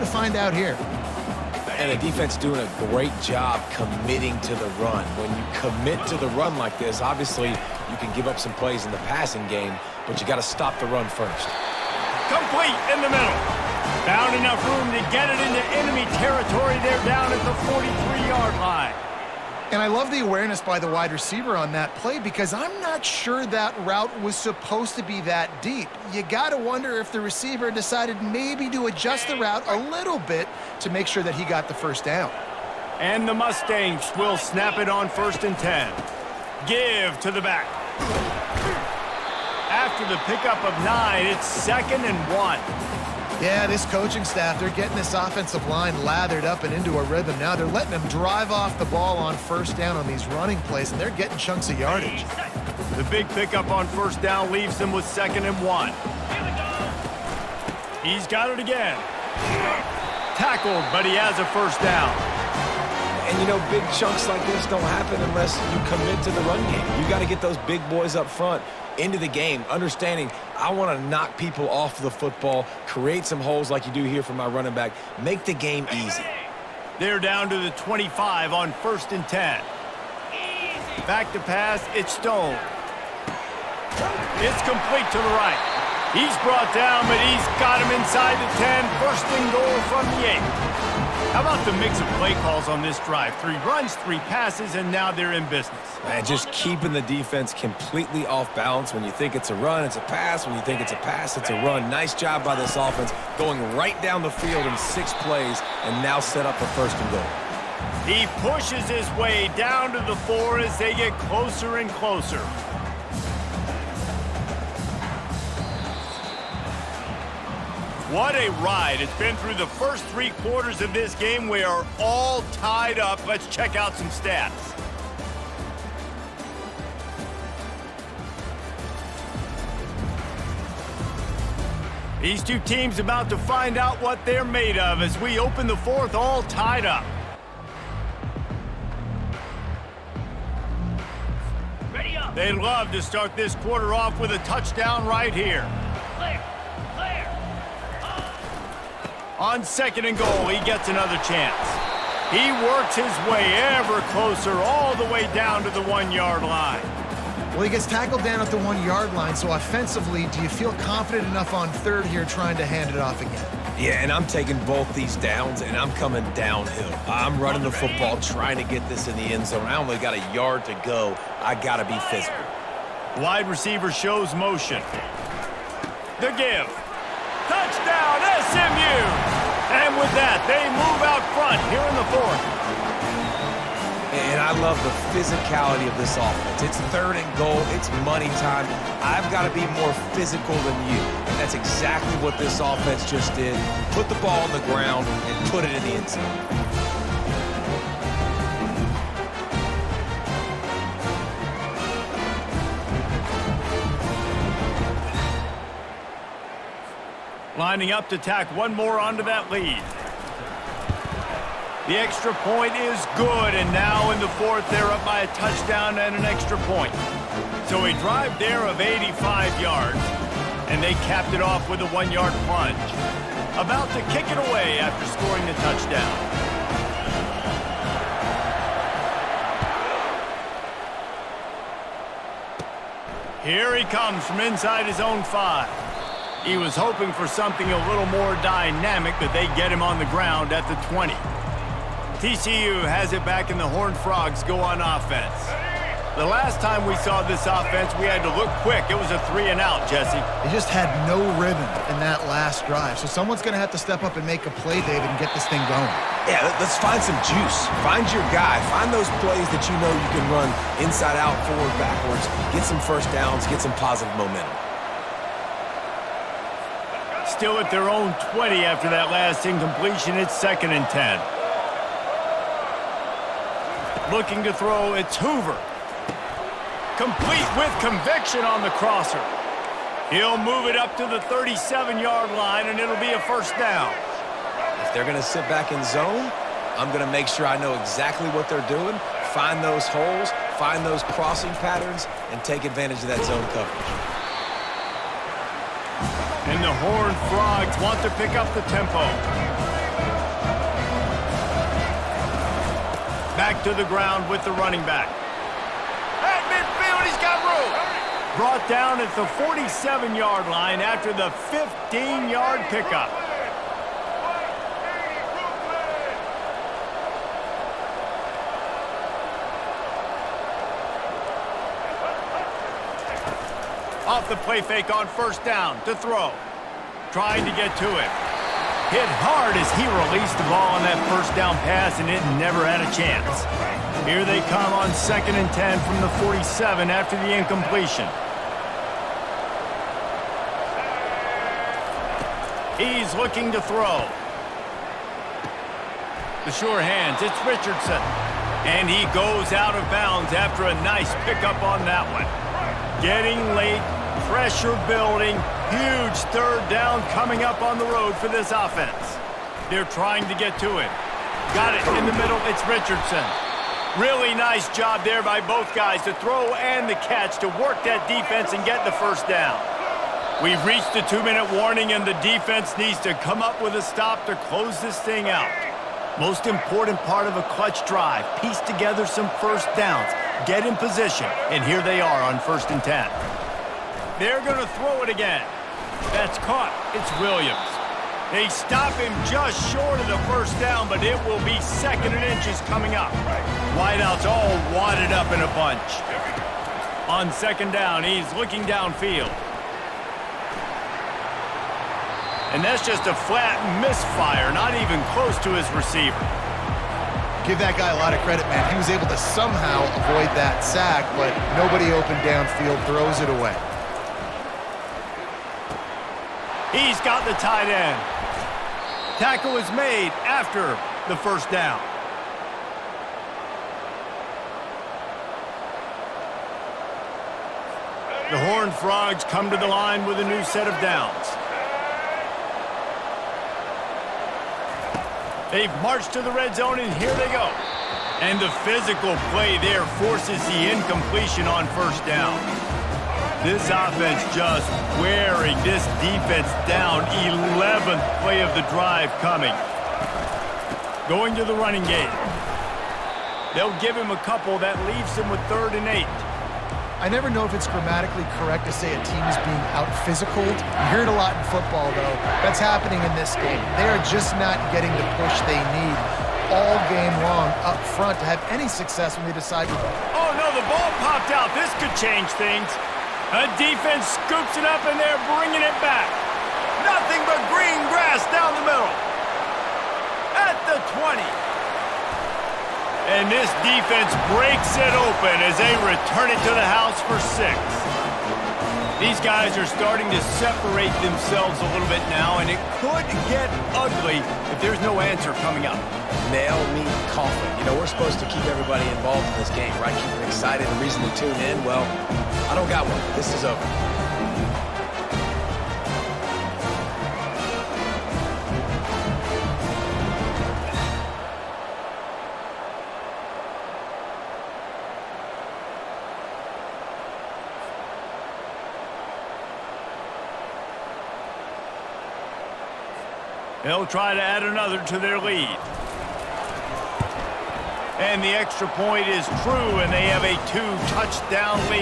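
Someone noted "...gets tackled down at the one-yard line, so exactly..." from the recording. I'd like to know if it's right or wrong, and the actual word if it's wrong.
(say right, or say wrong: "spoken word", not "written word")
wrong: "offensively", not "exactly".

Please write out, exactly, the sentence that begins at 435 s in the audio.
They've marched to the red zone, and here they go.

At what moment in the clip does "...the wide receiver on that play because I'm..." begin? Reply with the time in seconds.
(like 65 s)
20 s.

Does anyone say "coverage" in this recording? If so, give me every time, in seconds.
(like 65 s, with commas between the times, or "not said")
293 s.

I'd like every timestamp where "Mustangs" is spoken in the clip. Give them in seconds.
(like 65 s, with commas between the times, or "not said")
33 s.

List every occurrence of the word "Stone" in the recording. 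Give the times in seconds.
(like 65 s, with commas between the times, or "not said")
82 s.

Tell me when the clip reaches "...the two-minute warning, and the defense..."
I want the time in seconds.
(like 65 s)
370 s.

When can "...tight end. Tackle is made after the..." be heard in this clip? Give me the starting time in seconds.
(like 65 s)
417 s.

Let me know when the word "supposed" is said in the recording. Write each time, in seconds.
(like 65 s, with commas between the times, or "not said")
24 s, 497 s.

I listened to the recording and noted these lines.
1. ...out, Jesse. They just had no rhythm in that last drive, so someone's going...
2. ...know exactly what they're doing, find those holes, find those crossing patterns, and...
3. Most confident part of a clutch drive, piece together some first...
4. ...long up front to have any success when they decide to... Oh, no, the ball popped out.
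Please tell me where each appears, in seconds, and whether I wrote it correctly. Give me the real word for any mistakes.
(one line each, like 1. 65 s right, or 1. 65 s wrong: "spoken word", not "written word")
1. 249 s right
2. 287 s right
3. 376 s wrong: "important", not "confident"
4. 467 s right.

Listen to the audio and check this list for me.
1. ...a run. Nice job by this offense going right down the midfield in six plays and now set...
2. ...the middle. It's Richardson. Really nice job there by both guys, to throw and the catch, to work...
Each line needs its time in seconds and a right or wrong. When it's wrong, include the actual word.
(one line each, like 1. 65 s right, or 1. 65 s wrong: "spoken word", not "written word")
1. 101 s wrong: "field", not "midfield"
2. 362 s right.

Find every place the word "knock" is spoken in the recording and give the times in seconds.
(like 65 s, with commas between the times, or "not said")
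71 s.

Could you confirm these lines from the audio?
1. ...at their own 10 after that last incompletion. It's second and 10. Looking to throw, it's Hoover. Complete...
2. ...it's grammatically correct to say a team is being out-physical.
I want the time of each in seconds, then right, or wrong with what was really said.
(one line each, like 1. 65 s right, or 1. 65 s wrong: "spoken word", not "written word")
1. 267 s wrong: "20", not "10"
2. 457 s right.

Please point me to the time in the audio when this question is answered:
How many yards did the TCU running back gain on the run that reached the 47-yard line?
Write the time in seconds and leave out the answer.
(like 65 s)
311 s.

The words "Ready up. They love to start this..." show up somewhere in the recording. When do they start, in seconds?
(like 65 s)
141 s.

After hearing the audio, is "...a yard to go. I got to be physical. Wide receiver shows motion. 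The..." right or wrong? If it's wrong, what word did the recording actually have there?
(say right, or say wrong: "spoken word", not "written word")
right.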